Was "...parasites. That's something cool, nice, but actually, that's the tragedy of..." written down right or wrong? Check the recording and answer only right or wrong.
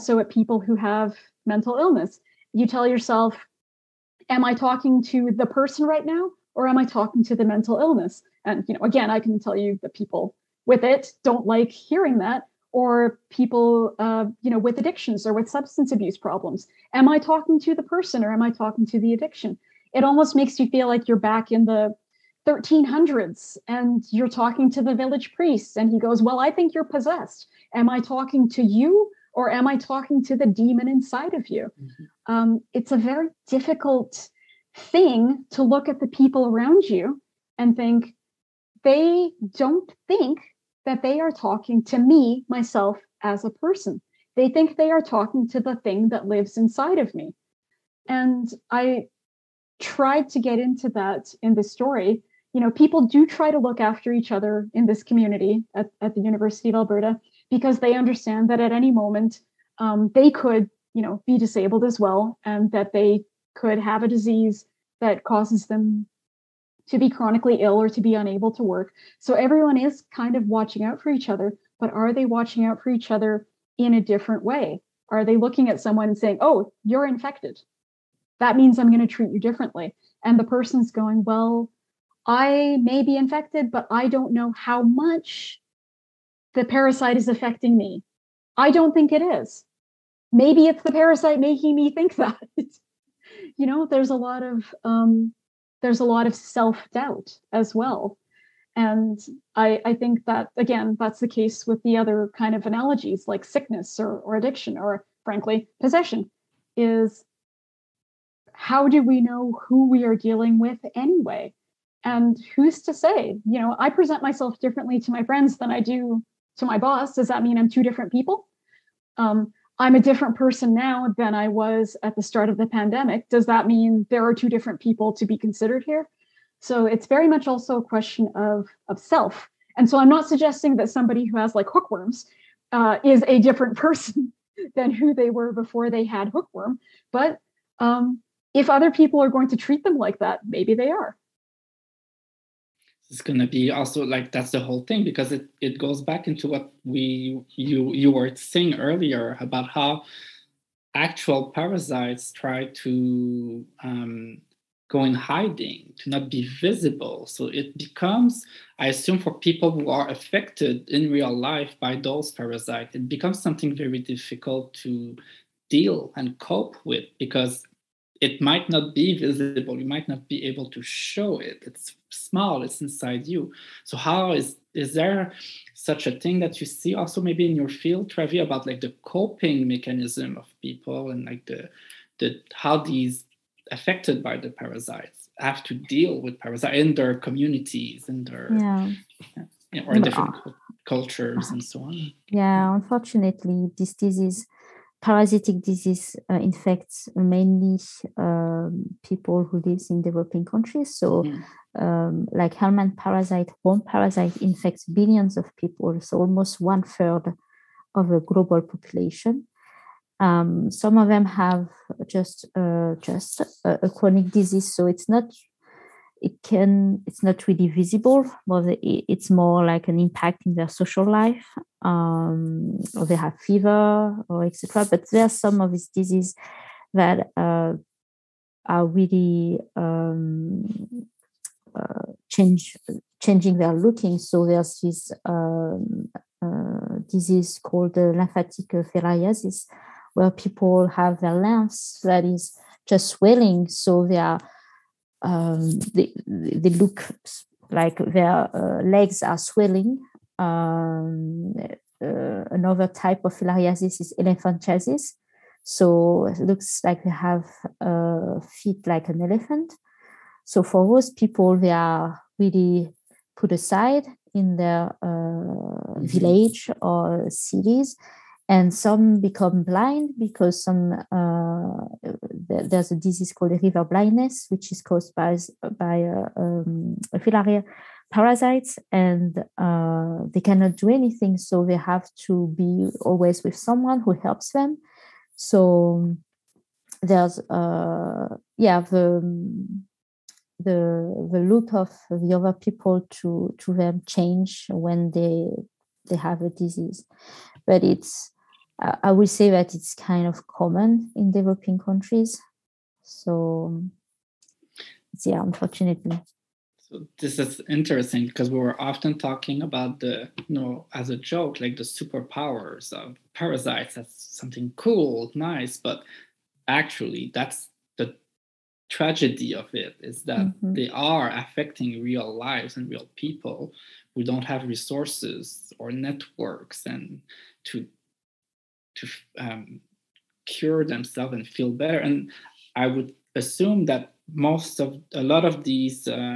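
right.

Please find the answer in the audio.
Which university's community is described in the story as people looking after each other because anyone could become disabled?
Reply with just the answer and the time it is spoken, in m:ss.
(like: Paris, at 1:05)
University of Alberta, at 0:56.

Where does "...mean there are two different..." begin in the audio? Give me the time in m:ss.
2:03.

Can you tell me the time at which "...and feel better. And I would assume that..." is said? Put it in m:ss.
5:31.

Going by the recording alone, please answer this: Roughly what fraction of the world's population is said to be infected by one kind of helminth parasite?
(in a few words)
one third.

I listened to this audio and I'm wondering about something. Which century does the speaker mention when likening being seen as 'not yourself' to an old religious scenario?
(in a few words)
1300s.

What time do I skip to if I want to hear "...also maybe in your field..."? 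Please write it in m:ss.
2:56.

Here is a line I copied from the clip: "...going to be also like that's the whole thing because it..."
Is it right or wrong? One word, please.
right.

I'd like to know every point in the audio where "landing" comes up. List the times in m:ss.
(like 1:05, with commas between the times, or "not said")
not said.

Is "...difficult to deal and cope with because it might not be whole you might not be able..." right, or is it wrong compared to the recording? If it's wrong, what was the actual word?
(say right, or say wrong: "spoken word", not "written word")
wrong: "visible", not "whole".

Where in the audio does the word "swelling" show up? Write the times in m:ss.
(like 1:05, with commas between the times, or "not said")
4:03, 4:09.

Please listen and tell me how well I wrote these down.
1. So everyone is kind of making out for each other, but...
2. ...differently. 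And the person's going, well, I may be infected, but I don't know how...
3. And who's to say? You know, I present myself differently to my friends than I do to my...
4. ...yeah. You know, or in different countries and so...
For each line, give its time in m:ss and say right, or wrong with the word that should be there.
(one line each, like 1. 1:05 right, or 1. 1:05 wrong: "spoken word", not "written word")
1. 1:09 wrong: "watching", not "making"
2. 1:19 right
3. 1:52 right
4. 3:08 wrong: "cultures", not "countries".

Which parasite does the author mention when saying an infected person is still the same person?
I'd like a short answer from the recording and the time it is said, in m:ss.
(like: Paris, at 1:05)
hookworms, at 2:11.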